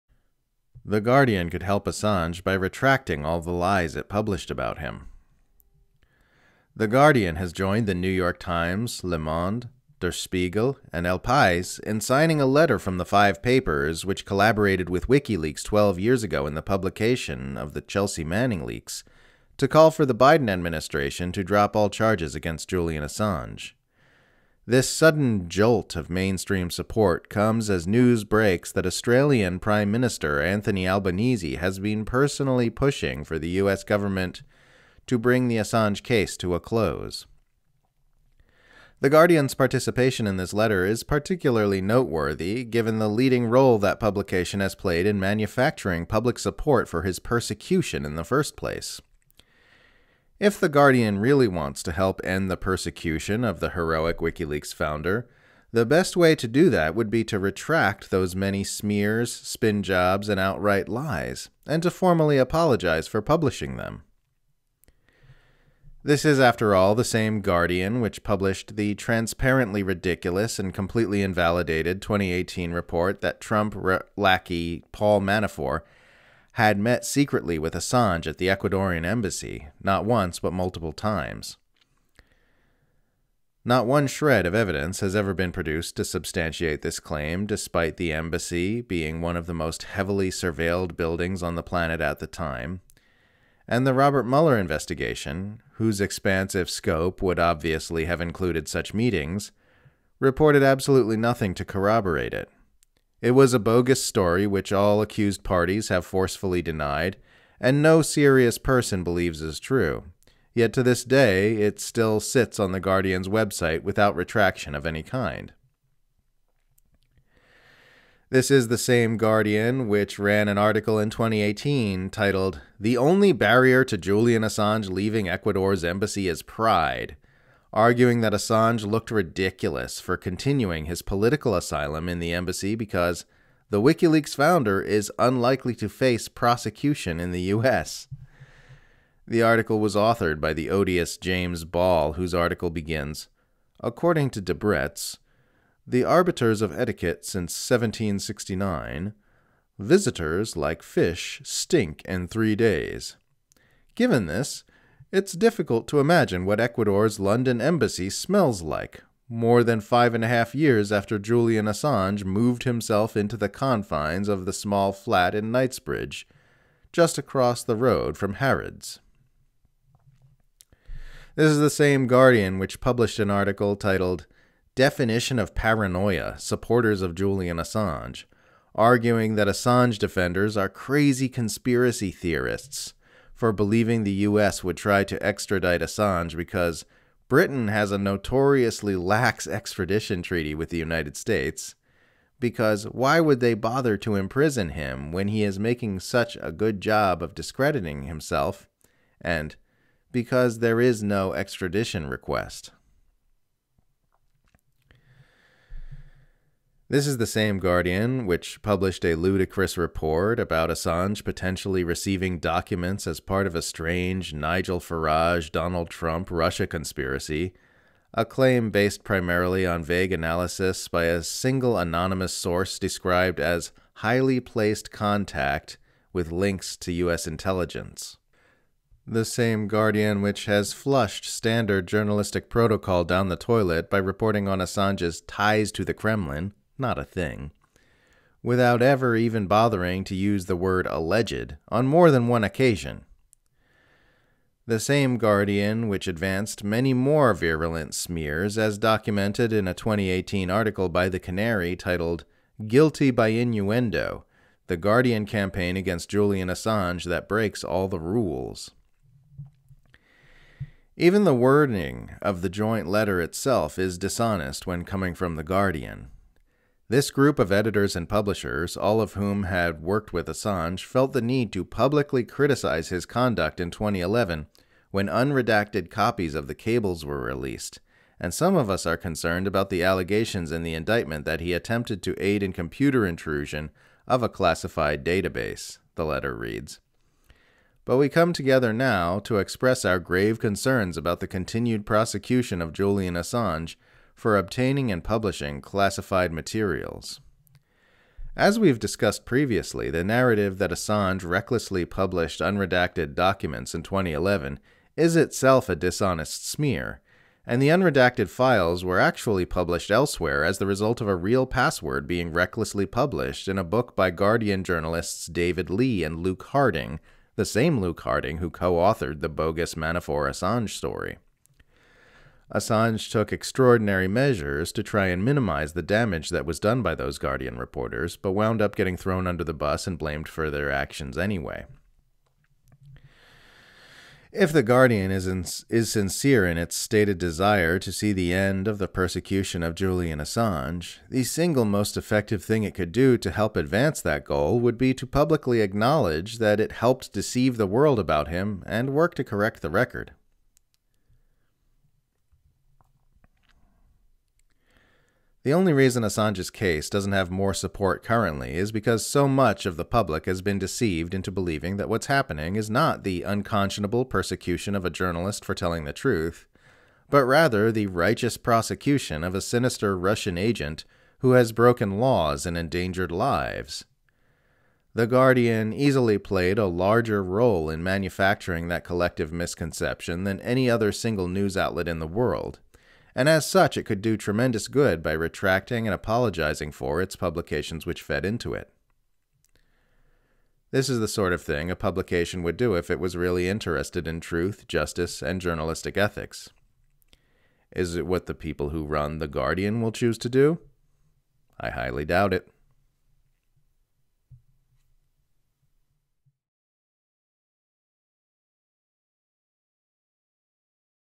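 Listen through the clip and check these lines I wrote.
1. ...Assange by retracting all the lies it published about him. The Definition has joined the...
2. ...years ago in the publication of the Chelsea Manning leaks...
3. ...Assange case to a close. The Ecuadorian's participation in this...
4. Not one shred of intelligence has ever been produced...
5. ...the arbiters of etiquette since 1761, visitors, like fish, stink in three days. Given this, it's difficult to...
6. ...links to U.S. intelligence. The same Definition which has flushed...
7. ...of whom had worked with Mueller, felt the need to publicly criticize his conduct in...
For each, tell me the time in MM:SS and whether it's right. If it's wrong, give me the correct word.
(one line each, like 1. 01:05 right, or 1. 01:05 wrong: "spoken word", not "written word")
1. 00:01 wrong: "Guardian", not "Definition"
2. 00:15 right
3. 00:35 wrong: "Guardian", not "Ecuadorian"
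4. 01:23 wrong: "evidence", not "intelligence"
5. 02:25 wrong: "1769", not "1761"
6. 03:46 wrong: "Guardian", not "Definition"
7. 04:28 wrong: "Assange", not "Mueller".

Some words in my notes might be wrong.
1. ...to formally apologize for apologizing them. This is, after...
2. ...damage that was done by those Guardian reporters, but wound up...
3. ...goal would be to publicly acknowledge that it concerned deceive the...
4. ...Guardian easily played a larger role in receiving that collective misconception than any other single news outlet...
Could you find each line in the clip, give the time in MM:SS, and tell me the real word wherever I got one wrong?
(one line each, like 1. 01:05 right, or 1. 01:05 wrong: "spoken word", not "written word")
1. 01:01 wrong: "publishing", not "apologizing"
2. 05:25 right
3. 05:44 wrong: "helped", not "concerned"
4. 06:15 wrong: "manufacturing", not "receiving".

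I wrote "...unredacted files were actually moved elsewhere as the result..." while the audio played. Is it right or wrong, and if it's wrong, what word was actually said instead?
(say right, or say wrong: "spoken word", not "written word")
wrong: "published", not "moved".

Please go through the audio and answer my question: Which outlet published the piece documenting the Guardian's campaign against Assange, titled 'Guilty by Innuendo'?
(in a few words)
The Canary.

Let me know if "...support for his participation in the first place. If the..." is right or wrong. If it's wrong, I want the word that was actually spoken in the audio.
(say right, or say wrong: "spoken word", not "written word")
wrong: "persecution", not "participation".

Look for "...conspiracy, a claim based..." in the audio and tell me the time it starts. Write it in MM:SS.
03:36.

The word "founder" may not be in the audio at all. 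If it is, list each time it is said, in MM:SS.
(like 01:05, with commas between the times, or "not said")
00:54, 02:14.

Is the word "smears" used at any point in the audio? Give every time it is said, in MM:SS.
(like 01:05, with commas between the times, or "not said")
00:58, 04:07, 05:06.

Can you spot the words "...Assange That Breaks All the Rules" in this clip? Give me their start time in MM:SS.
04:16.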